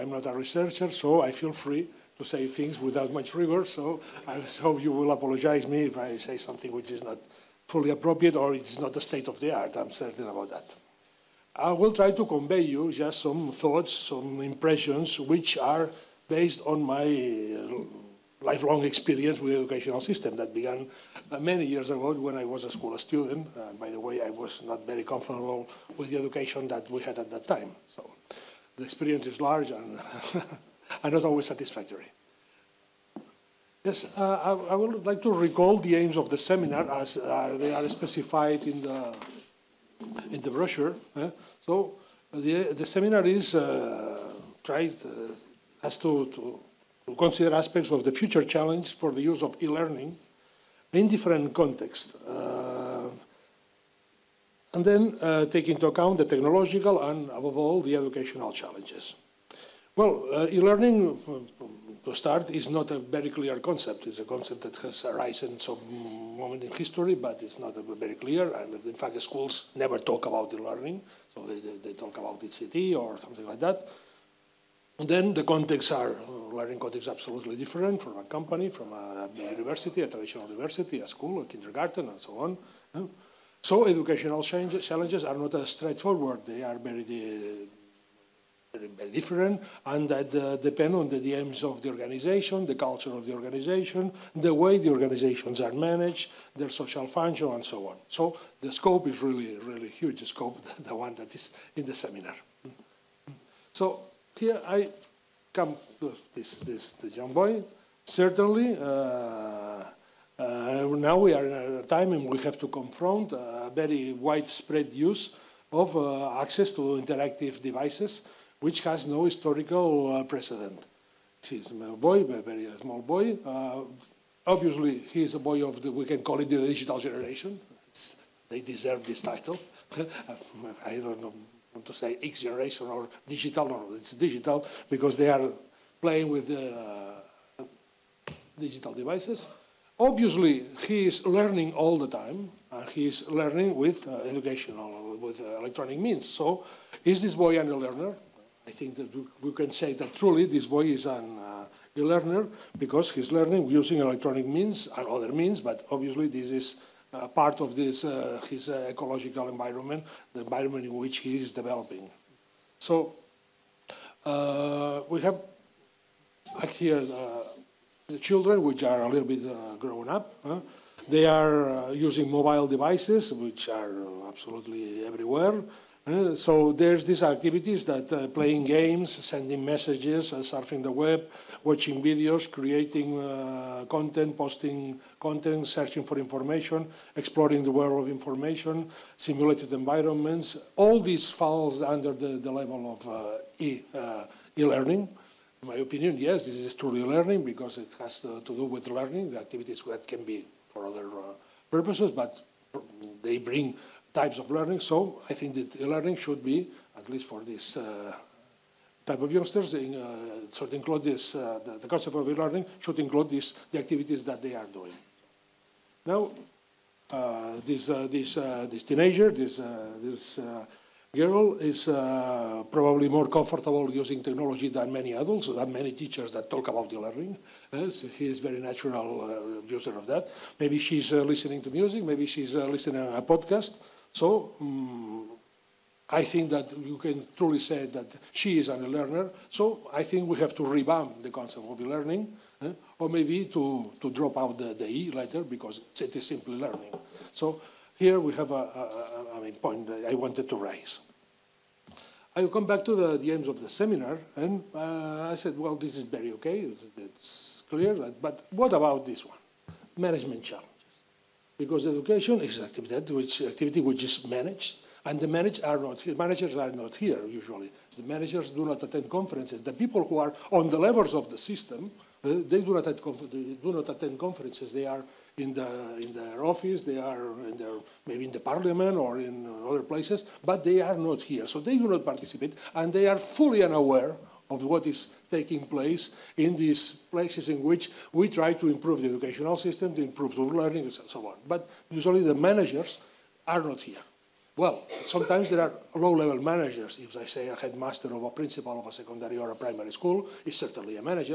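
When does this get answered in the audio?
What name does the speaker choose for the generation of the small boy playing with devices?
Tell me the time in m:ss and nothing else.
2:06.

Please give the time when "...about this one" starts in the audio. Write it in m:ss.
4:18.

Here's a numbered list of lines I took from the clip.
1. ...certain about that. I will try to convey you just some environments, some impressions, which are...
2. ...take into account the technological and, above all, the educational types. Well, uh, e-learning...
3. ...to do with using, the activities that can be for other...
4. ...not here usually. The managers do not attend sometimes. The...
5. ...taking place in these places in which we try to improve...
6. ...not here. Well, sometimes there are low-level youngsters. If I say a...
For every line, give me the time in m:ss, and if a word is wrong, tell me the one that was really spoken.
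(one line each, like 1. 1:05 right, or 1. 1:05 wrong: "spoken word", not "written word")
1. 0:09 wrong: "thoughts", not "environments"
2. 0:55 wrong: "challenges", not "types"
3. 3:18 wrong: "learning", not "using"
4. 4:26 wrong: "conferences", not "sometimes"
5. 4:45 right
6. 4:53 wrong: "managers", not "youngsters".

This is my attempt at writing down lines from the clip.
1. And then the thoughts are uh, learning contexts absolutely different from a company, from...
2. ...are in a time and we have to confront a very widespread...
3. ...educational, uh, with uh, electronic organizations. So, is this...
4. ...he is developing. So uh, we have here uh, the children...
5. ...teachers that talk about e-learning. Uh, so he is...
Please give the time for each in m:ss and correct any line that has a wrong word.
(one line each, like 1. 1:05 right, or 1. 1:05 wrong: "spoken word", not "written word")
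1. 1:14 wrong: "contexts", not "thoughts"
2. 1:51 right
3. 2:24 wrong: "means", not "organizations"
4. 2:41 right
5. 3:45 right.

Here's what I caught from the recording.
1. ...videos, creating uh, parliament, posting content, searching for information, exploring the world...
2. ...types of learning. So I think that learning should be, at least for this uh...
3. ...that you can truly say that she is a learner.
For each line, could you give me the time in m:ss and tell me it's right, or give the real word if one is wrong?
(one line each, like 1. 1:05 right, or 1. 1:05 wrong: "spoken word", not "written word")
1. 3:02 wrong: "content", not "parliament"
2. 3:24 right
3. 3:56 right.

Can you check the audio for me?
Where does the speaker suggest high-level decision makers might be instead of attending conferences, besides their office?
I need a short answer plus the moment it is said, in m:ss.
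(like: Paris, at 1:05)
the parliament, at 4:38.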